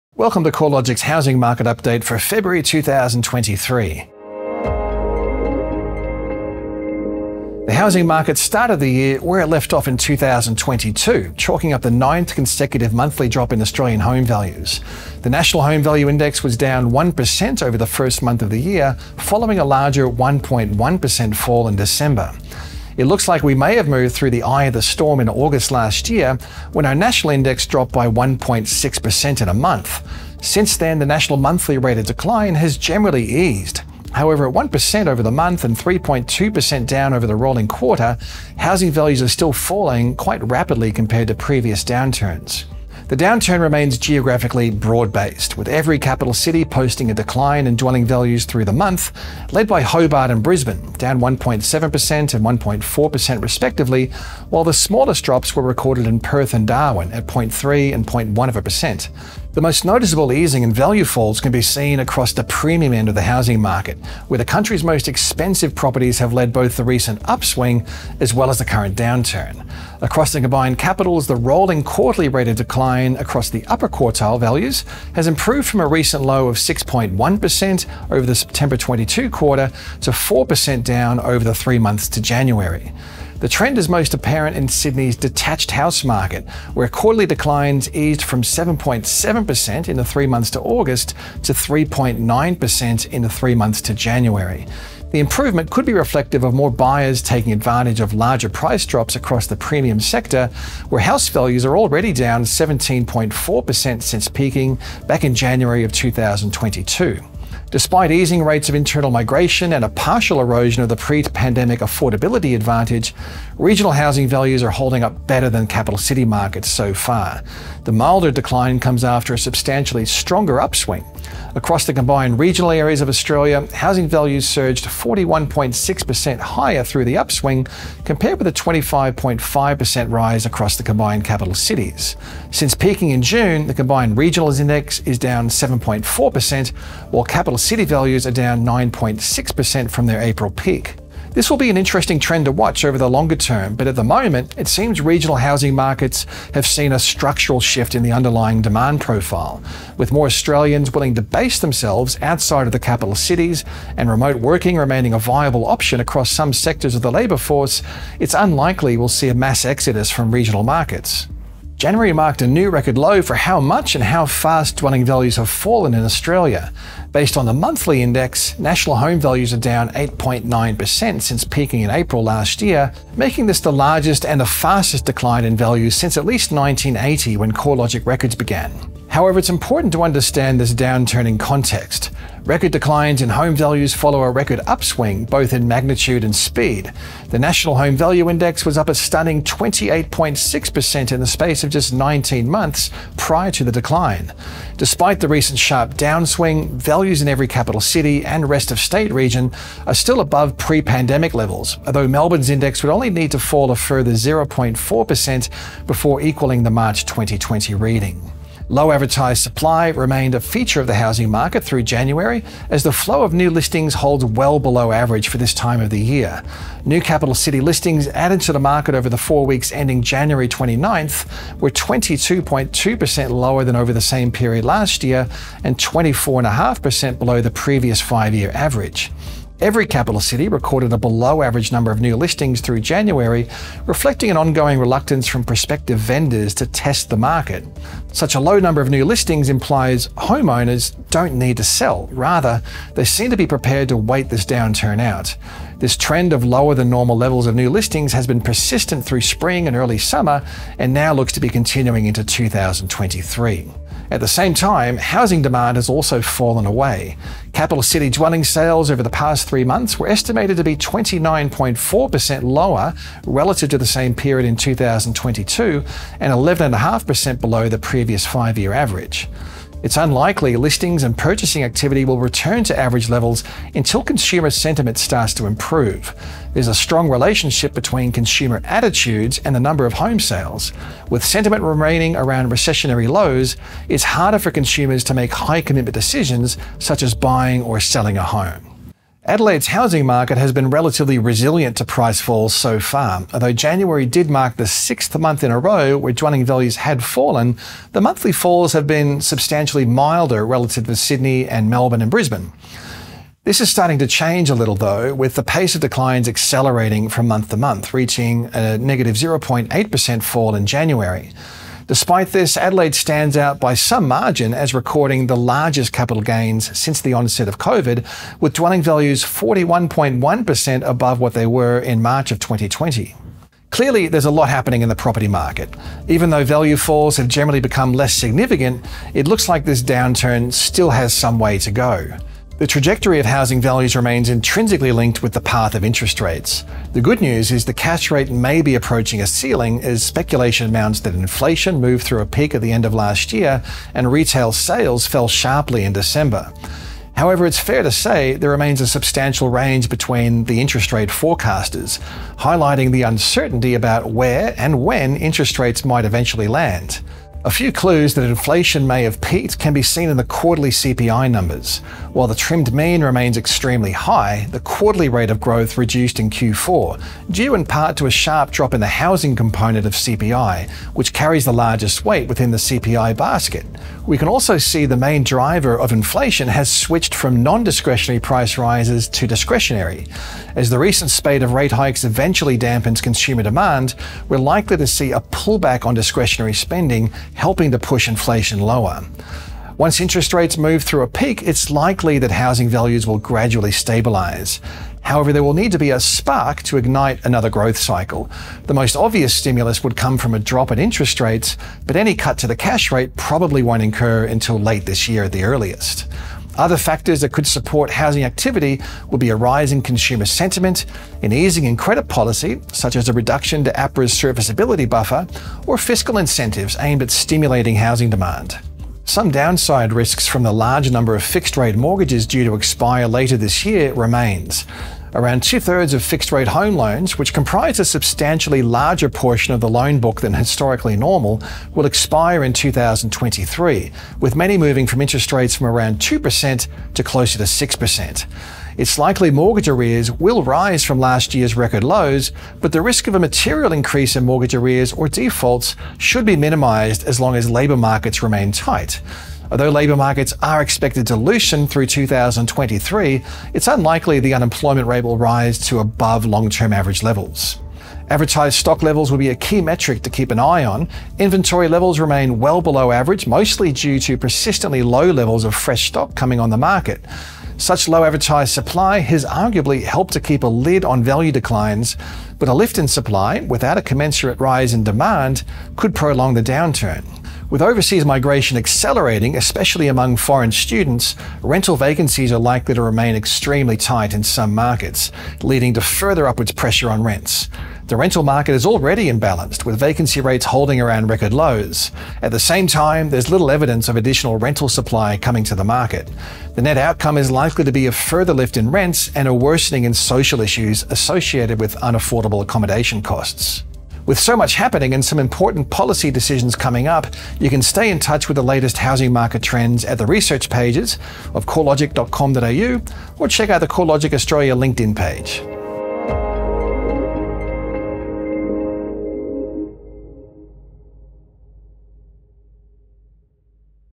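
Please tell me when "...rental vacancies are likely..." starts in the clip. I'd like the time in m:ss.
8:01.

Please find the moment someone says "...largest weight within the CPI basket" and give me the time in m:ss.
6:11.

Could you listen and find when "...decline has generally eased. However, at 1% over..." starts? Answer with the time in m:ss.
0:32.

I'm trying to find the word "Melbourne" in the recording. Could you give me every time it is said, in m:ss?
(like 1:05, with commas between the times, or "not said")
3:22, 5:01.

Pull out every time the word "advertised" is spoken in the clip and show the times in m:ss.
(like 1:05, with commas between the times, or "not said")
3:28, 7:38, 7:48.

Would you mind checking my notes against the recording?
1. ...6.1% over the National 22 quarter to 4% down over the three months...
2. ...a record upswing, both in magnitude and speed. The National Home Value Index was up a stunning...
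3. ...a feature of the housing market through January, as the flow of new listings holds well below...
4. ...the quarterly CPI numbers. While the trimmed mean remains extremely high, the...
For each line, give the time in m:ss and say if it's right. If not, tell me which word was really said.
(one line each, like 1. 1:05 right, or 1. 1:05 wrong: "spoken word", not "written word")
1. 1:16 wrong: "September", not "National"
2. 3:04 right
3. 3:30 right
4. 6:00 right.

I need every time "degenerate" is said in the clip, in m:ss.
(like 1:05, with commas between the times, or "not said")
not said.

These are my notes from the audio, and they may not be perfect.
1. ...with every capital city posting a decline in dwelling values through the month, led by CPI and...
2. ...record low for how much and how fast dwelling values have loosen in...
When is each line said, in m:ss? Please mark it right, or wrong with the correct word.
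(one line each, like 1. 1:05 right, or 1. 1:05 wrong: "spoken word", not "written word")
1. 0:45 wrong: "Hobart", not "CPI"
2. 2:42 wrong: "fallen", not "loosen".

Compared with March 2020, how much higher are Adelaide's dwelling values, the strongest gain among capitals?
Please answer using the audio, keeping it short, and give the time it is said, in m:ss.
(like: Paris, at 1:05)
41.1%, at 5:19.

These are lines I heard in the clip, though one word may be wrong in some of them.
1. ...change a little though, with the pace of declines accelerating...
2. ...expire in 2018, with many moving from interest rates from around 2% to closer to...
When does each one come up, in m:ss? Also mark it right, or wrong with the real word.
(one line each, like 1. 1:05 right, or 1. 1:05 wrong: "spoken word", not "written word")
1. 5:04 right
2. 7:11 wrong: "2023", not "2018".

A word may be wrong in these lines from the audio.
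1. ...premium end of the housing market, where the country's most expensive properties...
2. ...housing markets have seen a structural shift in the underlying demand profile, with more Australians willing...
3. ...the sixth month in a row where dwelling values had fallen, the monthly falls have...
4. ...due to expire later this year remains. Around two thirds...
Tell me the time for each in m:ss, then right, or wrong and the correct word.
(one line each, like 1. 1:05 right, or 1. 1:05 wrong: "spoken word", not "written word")
1. 1:02 right
2. 2:25 right
3. 4:54 right
4. 7:02 right.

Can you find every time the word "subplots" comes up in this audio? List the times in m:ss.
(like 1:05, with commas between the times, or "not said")
not said.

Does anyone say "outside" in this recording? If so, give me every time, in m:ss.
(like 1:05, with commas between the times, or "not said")
2:32.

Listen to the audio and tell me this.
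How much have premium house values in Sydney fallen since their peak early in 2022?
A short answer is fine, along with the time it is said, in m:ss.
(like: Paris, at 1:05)
17.4%, at 1:42.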